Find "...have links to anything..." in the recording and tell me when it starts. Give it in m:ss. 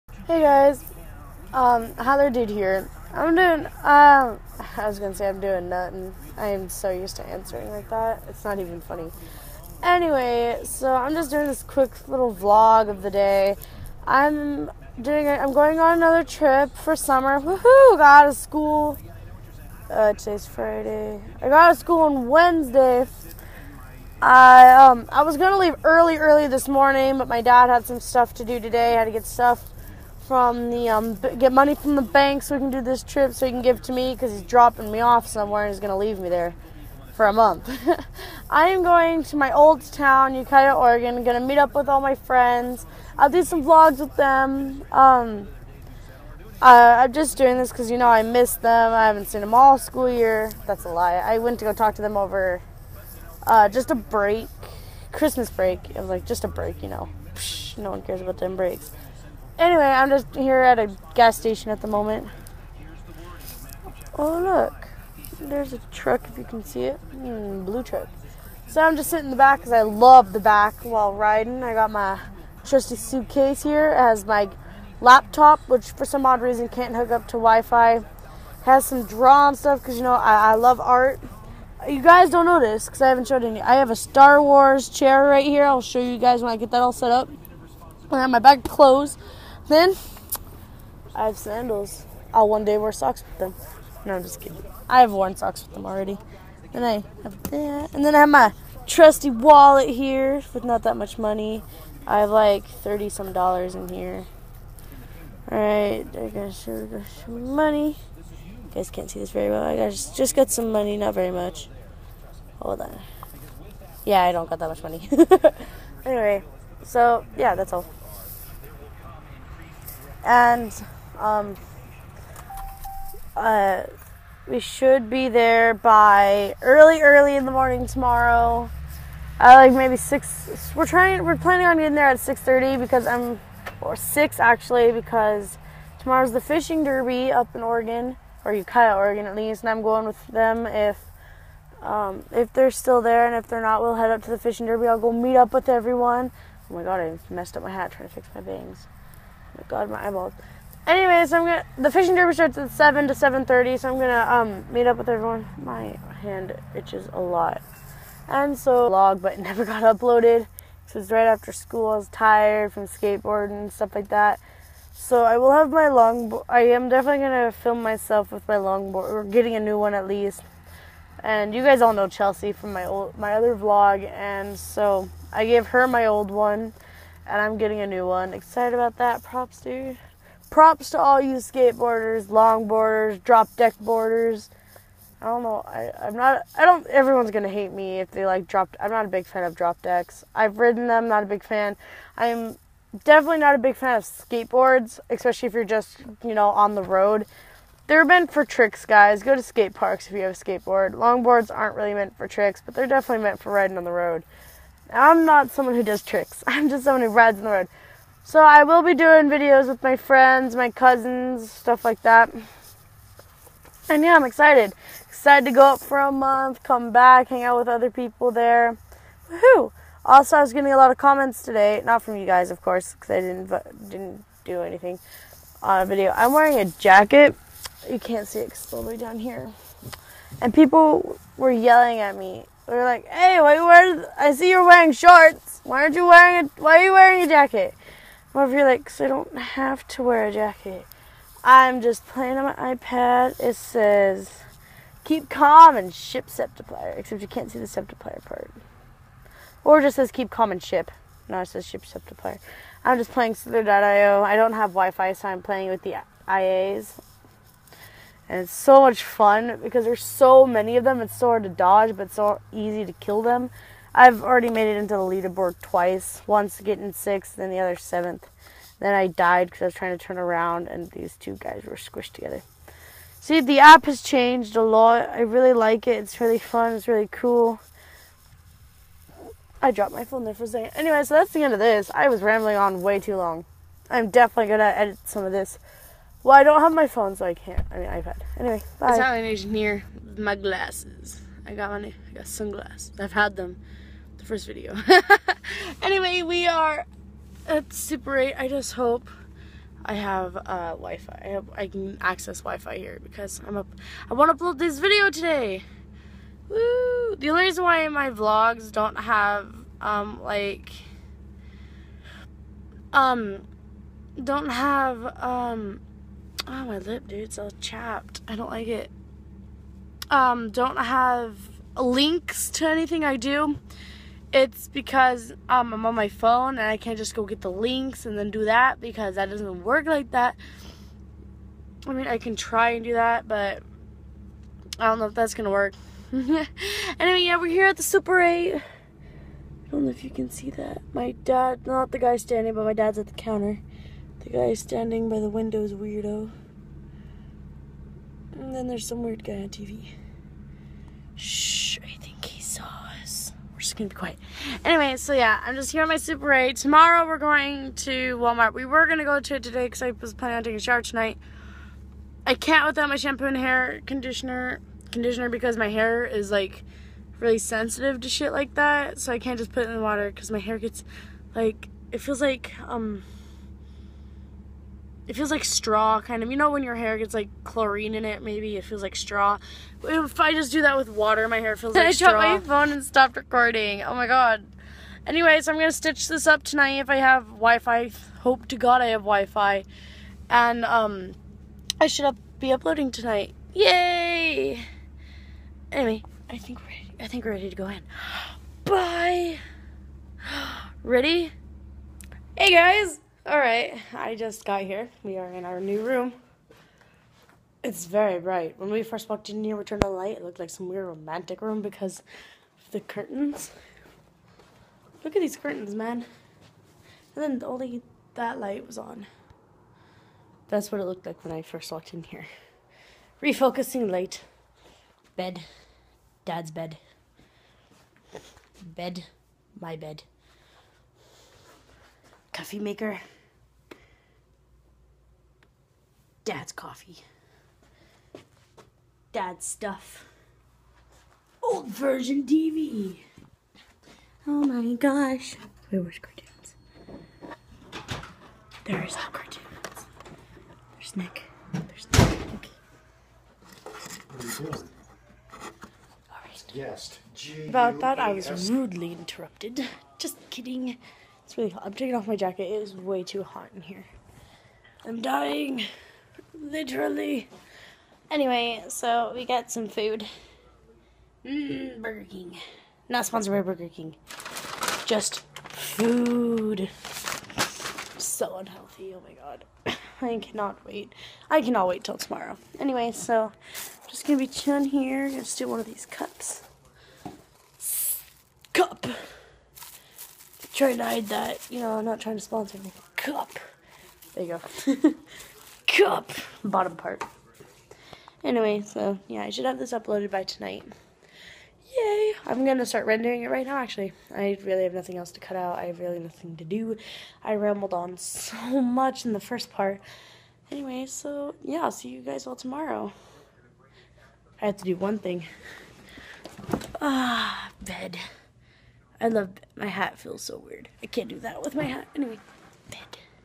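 5:20.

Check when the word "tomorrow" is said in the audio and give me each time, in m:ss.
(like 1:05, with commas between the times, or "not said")
2:07, 2:15, 5:56, 8:01, 8:32.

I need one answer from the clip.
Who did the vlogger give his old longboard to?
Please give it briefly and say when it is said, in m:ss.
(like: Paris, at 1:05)
Chelsea, at 2:52.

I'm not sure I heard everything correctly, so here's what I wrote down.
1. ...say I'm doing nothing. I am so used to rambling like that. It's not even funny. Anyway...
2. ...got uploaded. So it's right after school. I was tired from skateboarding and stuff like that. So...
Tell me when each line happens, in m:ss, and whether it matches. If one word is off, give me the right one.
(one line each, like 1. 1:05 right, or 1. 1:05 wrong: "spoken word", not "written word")
1. 0:05 wrong: "answering", not "rambling"
2. 2:39 right.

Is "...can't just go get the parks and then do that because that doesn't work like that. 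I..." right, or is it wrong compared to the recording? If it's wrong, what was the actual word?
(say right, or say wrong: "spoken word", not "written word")
wrong: "links", not "parks".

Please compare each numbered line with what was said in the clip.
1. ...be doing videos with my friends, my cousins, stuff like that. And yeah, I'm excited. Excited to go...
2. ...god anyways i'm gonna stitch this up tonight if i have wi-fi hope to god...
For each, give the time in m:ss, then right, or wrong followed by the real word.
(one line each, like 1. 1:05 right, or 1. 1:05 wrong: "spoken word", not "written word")
1. 3:28 right
2. 6:24 right.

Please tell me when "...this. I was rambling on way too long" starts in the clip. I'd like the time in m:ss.
4:41.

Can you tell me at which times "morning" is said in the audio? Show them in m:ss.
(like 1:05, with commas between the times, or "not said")
0:26, 2:07.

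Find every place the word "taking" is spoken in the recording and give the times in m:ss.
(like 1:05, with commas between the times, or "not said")
6:00, 7:41.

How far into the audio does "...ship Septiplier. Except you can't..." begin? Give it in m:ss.
4:05.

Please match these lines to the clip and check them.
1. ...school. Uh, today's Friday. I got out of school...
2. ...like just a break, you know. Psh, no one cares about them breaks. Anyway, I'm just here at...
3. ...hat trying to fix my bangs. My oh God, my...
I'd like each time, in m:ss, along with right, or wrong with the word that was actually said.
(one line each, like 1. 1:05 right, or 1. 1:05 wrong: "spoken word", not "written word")
1. 0:18 right
2. 0:56 right
3. 2:27 right.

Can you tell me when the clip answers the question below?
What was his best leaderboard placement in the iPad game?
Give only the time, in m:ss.
4:26.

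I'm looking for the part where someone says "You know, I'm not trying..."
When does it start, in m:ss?
8:11.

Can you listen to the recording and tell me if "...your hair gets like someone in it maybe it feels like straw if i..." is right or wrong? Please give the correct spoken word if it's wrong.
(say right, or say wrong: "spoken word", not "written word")
wrong: "chlorine", not "someone".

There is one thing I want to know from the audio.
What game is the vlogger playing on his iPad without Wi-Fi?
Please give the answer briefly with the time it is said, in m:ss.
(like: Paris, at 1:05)
Slither.io, at 4:13.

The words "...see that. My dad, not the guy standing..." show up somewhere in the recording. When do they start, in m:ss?
5:40.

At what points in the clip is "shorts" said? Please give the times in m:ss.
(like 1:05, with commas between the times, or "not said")
3:54.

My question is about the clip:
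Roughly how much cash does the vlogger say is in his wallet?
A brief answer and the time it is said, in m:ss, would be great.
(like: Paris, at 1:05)
30 some dollars, at 1:42.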